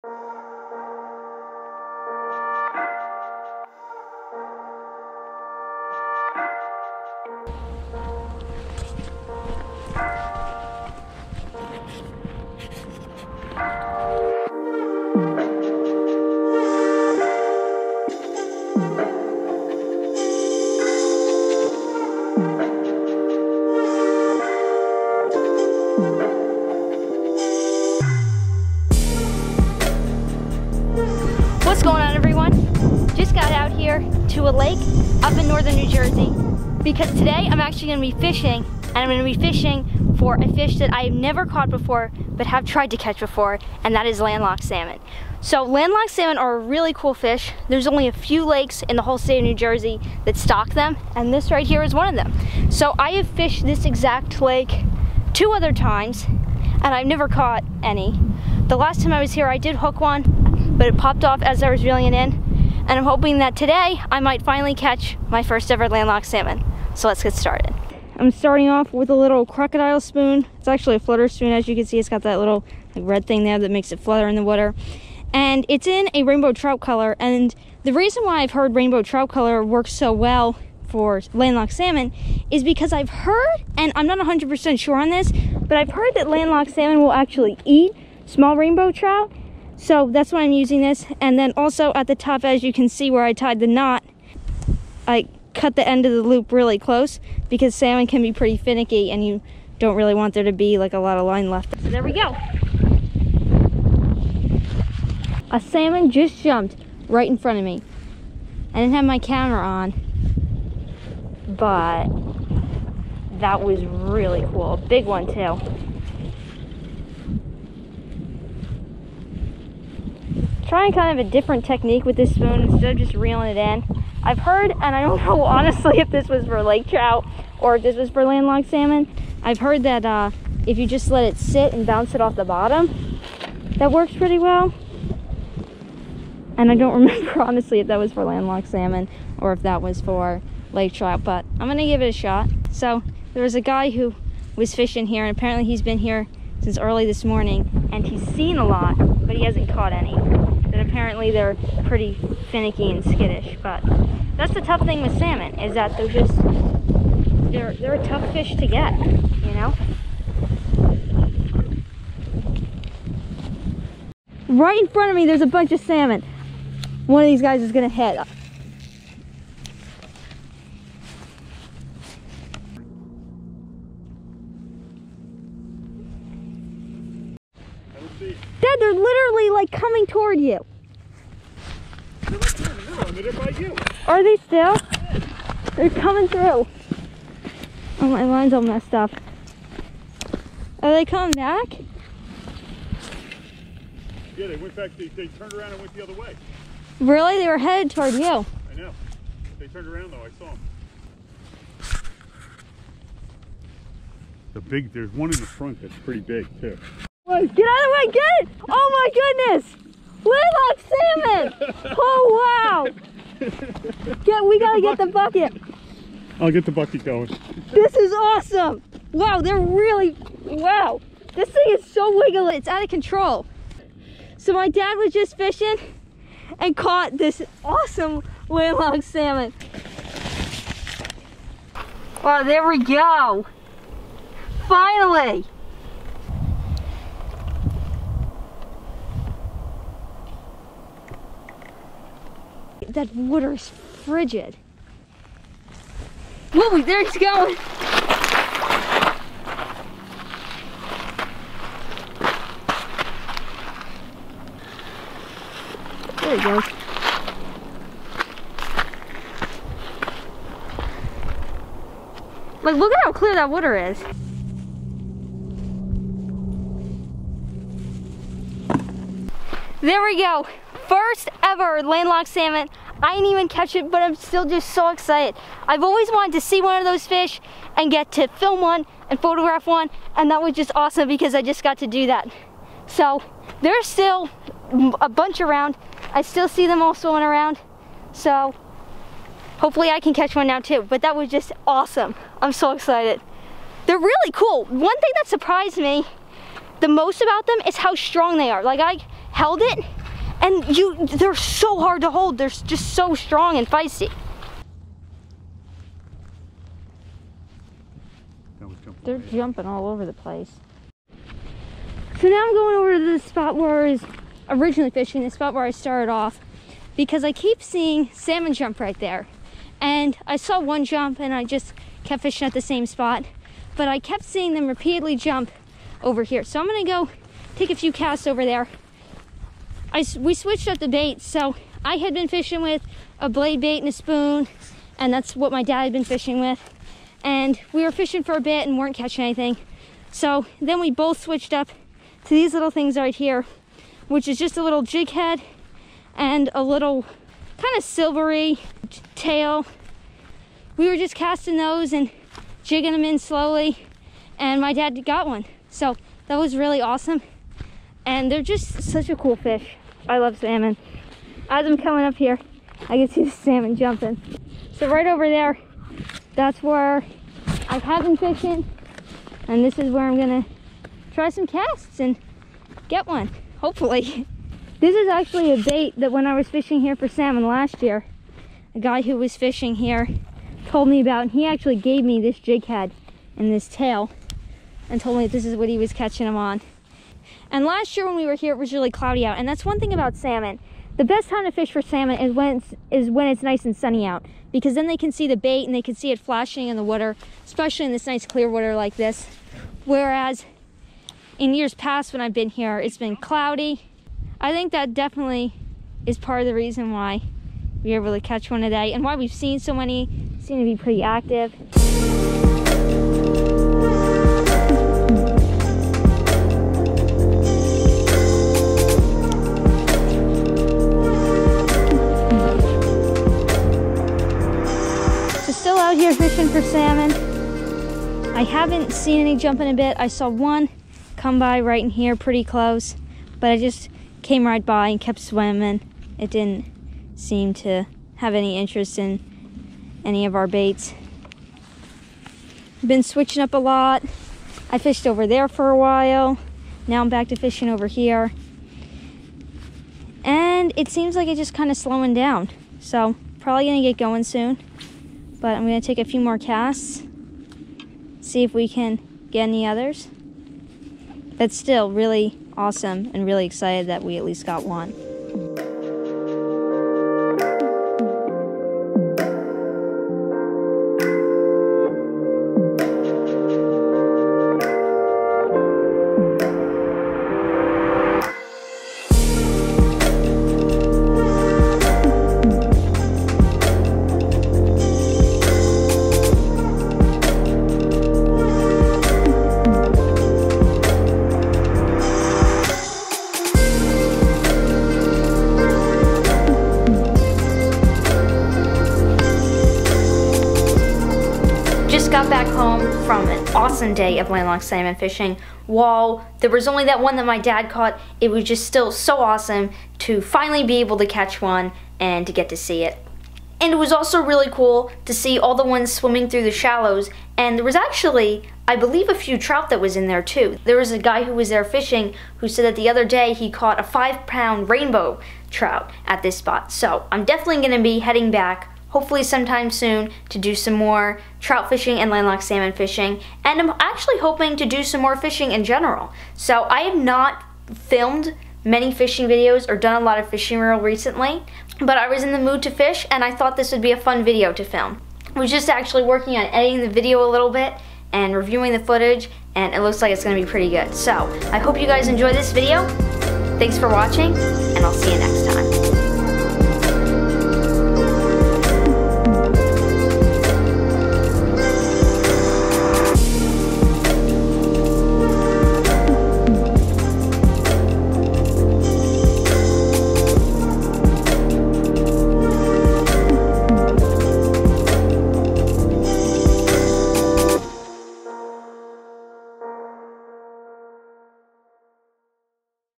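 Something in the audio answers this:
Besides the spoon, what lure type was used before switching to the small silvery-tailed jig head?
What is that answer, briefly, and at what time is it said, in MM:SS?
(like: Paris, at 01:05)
Blade bait, at 05:33.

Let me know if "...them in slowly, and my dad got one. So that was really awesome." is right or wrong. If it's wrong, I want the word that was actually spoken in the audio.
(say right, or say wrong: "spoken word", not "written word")
right.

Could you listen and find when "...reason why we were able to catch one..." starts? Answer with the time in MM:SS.
06:46.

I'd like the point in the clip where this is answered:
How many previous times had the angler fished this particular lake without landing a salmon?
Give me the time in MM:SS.
00:55.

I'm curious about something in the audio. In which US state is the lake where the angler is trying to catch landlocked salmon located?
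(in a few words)
New Jersey.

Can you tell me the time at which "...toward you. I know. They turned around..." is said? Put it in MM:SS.
03:17.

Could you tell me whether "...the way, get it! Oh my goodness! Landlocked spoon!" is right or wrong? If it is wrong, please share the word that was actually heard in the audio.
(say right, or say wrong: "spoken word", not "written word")
wrong: "salmon", not "spoon".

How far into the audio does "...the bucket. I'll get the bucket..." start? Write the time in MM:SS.
03:34.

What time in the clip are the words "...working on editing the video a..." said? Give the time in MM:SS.
09:06.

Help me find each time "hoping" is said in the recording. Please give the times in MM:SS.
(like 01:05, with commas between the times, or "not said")
01:03, 08:54.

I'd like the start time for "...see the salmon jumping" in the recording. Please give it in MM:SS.
06:03.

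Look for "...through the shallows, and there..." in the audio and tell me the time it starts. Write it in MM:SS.
08:36.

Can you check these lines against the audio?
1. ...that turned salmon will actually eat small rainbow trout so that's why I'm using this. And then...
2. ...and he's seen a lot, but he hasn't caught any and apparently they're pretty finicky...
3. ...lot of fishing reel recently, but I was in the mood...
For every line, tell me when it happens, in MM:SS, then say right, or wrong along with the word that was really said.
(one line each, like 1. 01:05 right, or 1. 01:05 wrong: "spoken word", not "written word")
1. 01:26 wrong: "landlocked", not "turned"
2. 02:27 right
3. 09:00 right.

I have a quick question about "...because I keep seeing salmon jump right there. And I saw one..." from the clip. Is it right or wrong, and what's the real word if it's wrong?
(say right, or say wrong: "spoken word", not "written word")
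right.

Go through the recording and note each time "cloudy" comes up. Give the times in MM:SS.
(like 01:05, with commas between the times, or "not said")
06:28, 06:43.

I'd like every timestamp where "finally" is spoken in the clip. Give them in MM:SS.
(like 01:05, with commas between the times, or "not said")
01:04, 03:54, 08:30.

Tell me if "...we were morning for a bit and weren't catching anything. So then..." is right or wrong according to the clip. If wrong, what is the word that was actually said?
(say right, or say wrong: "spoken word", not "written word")
wrong: "fishing", not "morning".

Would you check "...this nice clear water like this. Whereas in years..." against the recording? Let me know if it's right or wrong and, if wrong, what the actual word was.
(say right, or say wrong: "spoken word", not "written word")
right.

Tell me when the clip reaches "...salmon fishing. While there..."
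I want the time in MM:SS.
08:24.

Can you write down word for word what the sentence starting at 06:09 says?
And this is where I'm gonna try some casts and get one, hopefully.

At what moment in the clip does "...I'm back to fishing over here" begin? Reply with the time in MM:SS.
07:27.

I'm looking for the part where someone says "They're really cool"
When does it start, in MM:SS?
04:53.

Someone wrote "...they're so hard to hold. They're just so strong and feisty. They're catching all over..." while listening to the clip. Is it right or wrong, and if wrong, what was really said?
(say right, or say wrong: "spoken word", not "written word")
wrong: "jumping", not "catching".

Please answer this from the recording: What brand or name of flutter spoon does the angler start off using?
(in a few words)
Crocodile spoon.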